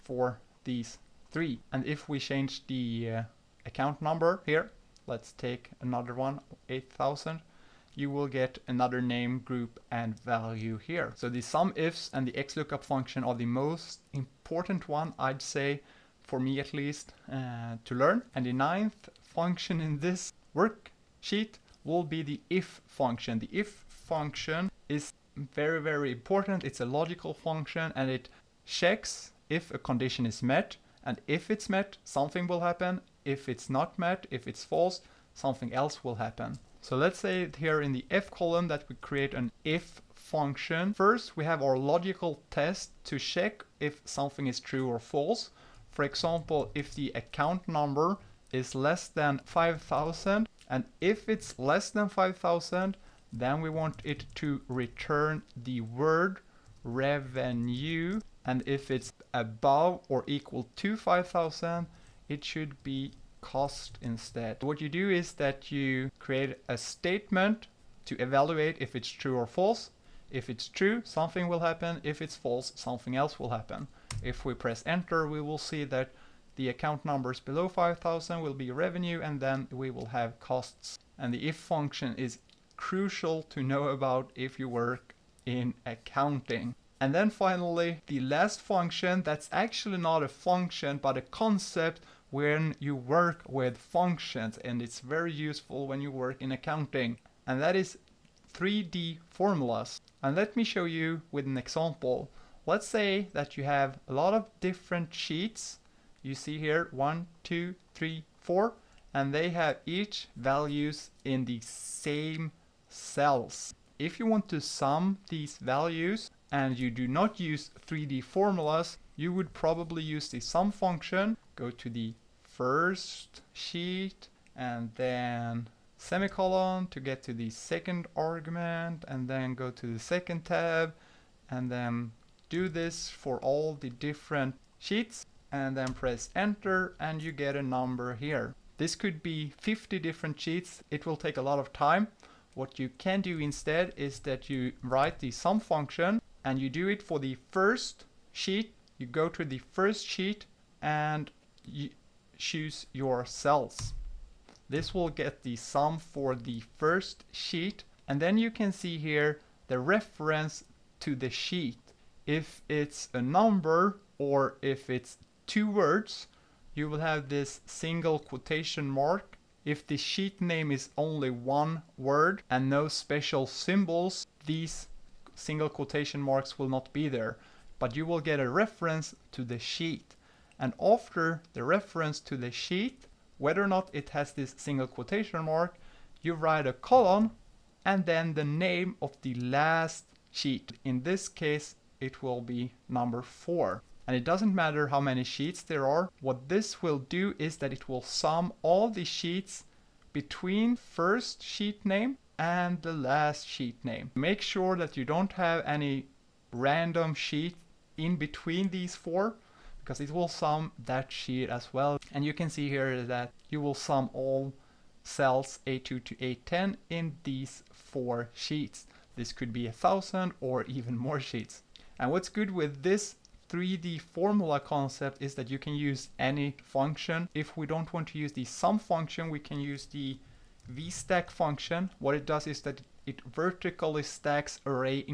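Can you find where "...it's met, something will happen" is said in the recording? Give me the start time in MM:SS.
00:31.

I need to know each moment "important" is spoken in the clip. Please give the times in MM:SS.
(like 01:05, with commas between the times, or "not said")
00:14, 00:26.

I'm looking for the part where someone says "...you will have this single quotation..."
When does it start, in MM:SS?
02:46.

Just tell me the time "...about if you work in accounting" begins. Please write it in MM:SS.
01:23.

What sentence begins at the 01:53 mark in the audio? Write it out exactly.
If you want to sum these values and you do not use 3D formulas, you would probably use the sum function.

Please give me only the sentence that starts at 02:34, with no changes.
This will get the sum for the first sheet and then you can see here the reference to the sheet.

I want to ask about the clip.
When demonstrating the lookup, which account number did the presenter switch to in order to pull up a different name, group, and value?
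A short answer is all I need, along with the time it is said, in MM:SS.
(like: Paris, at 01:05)
8000, at 00:06.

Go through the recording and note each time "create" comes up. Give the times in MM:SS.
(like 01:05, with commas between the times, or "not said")
00:39, 01:06.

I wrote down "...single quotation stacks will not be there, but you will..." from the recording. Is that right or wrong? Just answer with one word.
wrong.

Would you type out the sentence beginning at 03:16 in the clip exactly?
What this will do is that it will sum all the sheets between first sheet name and the last sheet name.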